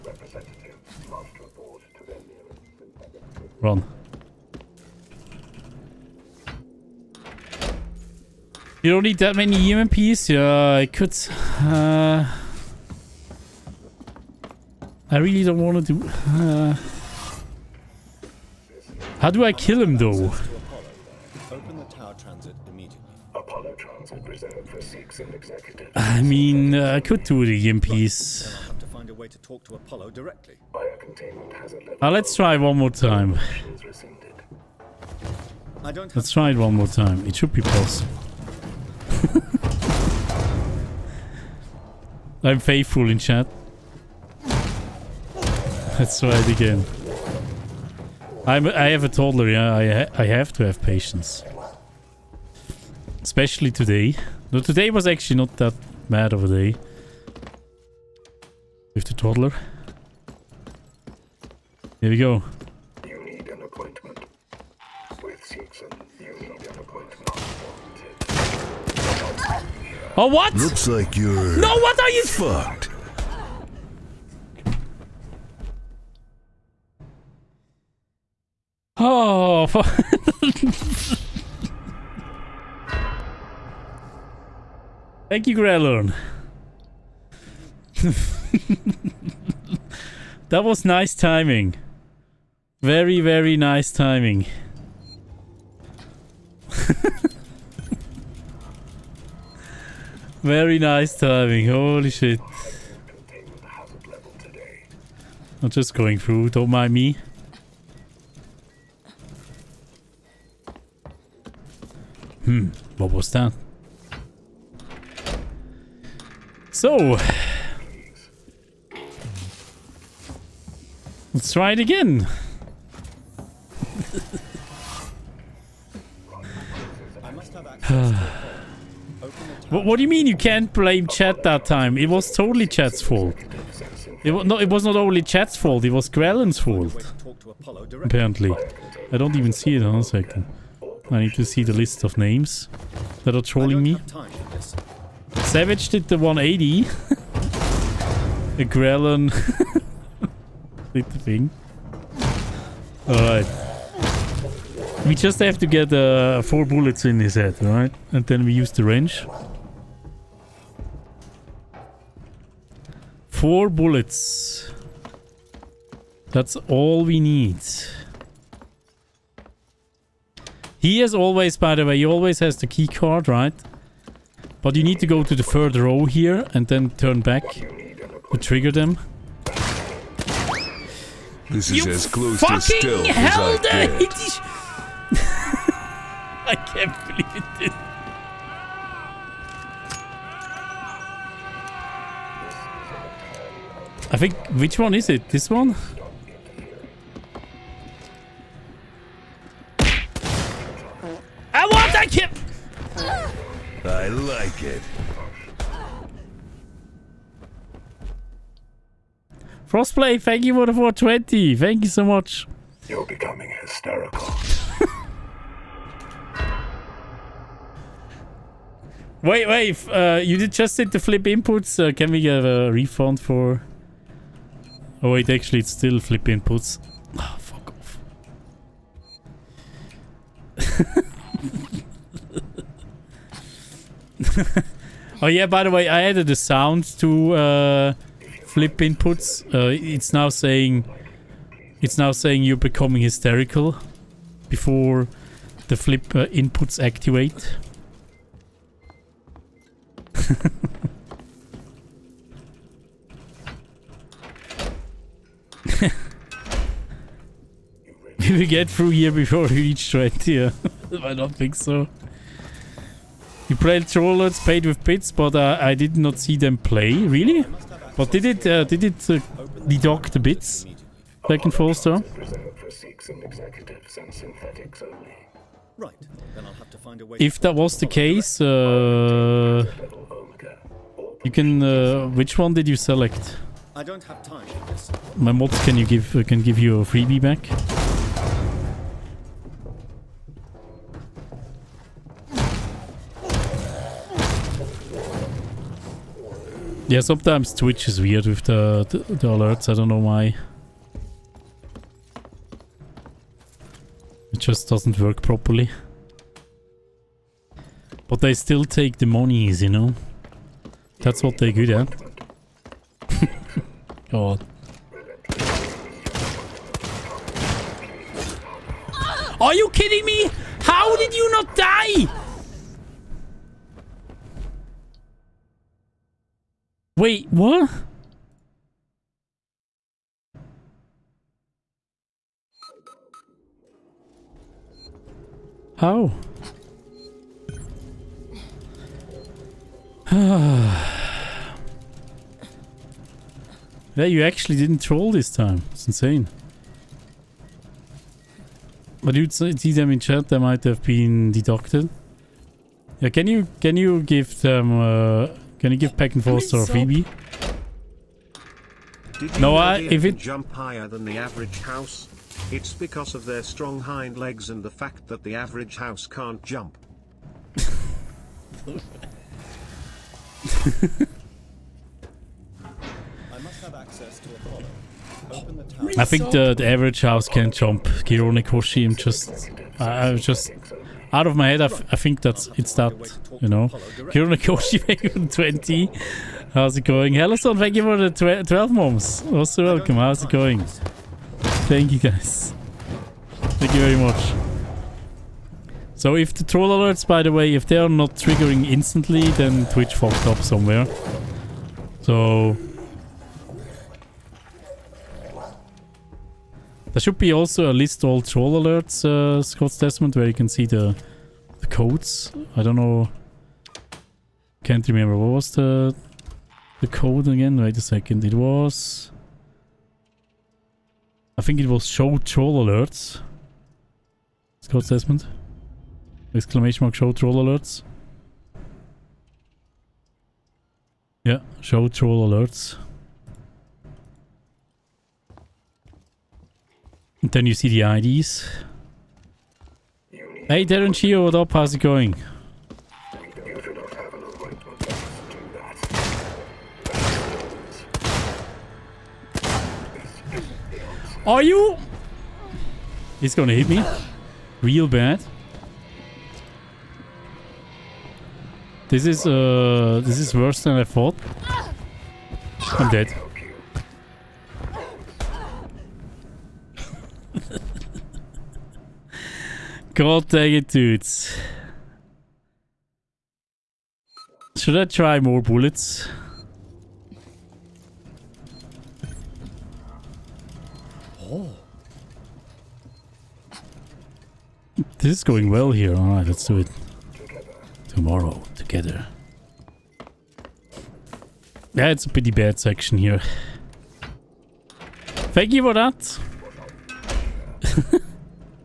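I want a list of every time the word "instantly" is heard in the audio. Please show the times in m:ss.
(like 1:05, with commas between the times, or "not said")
6:38.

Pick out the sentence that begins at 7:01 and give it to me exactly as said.
I think it was show troll alerts.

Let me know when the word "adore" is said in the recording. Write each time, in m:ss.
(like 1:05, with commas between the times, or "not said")
not said.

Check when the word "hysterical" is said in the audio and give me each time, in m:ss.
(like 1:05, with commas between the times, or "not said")
3:33, 4:03.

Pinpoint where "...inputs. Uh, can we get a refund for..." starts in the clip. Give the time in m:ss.
3:41.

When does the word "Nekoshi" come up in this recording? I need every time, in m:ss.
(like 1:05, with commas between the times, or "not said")
6:18, 6:24.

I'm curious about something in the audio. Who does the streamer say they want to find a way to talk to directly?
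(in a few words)
Apollo.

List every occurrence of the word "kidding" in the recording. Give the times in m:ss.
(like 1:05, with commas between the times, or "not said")
5:19.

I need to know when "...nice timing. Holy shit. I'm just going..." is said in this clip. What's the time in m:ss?
1:40.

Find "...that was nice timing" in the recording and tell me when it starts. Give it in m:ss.
1:30.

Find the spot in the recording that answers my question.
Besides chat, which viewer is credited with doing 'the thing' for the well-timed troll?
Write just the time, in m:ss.
2:16.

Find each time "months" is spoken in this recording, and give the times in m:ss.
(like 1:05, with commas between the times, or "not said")
6:28.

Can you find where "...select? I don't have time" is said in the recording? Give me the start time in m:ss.
4:42.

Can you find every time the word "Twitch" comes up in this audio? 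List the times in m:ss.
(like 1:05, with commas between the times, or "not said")
4:57, 6:39.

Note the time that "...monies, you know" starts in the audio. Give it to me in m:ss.
5:09.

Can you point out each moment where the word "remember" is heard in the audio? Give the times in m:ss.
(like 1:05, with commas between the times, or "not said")
6:54.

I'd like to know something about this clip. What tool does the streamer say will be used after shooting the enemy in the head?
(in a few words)
wrench.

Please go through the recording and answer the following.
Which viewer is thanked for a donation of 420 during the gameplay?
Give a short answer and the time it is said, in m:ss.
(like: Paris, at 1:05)
Frostplay, at 3:29.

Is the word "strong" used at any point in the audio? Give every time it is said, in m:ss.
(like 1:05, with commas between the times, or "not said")
6:03.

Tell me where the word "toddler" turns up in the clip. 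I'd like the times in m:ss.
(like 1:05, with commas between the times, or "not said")
0:49, 0:59.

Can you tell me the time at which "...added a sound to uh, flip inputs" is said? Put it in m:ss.
3:56.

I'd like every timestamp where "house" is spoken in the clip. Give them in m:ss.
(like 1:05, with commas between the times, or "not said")
6:01, 6:05, 6:17.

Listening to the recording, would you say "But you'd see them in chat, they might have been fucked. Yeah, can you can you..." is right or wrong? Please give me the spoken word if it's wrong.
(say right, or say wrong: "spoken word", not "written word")
wrong: "deducted", not "fucked".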